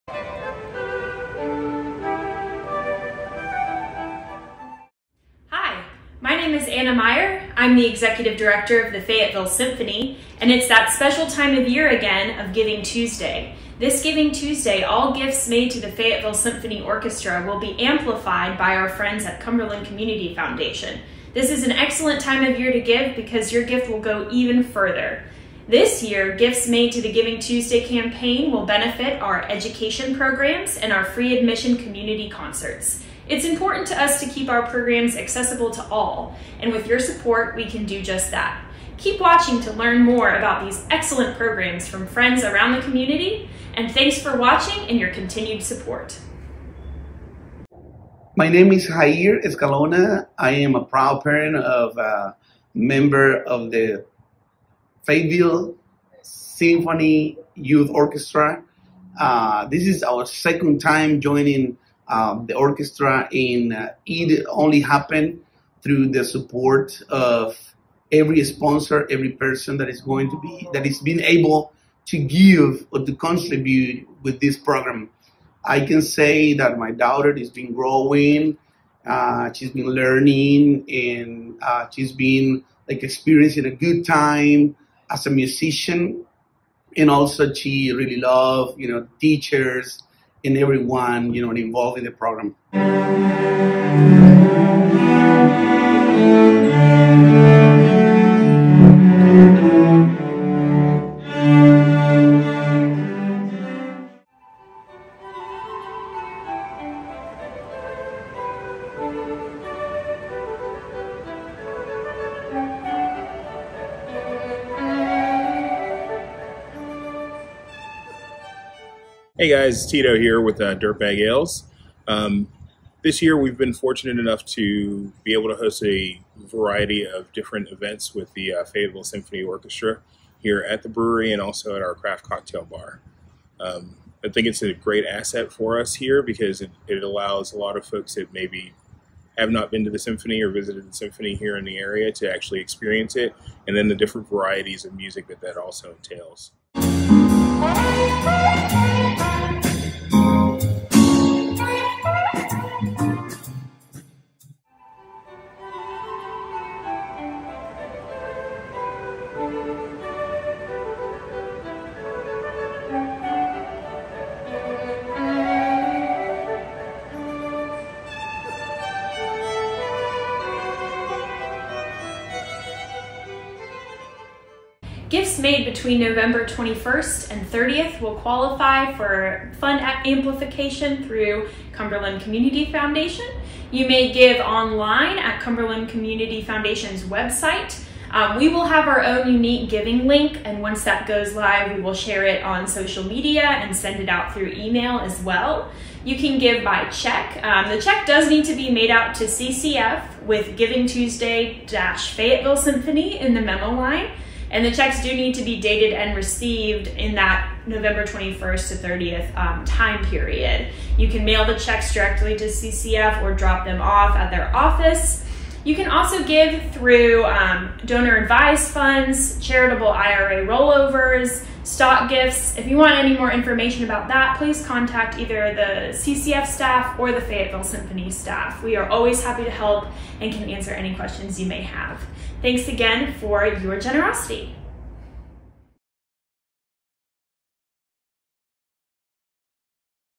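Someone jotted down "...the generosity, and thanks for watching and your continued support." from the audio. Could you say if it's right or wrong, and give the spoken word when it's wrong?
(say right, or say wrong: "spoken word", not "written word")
wrong: "community", not "generosity".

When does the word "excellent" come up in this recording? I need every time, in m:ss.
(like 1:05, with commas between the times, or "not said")
0:21, 0:40.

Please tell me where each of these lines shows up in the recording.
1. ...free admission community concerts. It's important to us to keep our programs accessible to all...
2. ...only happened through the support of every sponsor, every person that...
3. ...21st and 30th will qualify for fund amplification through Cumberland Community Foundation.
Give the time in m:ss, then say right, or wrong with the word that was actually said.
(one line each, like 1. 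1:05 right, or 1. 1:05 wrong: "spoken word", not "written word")
1. 0:31 right
2. 1:04 right
3. 2:56 right.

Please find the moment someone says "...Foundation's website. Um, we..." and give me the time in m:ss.
3:06.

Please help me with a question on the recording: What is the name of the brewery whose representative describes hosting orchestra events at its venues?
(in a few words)
Dirtbag Ales.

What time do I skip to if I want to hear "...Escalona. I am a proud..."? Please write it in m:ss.
0:49.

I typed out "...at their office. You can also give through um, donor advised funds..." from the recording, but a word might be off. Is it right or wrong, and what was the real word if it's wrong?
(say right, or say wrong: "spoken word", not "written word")
right.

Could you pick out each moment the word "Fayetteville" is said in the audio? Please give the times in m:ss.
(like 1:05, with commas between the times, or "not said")
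0:08, 0:15, 0:55, 2:08, 3:21, 3:47.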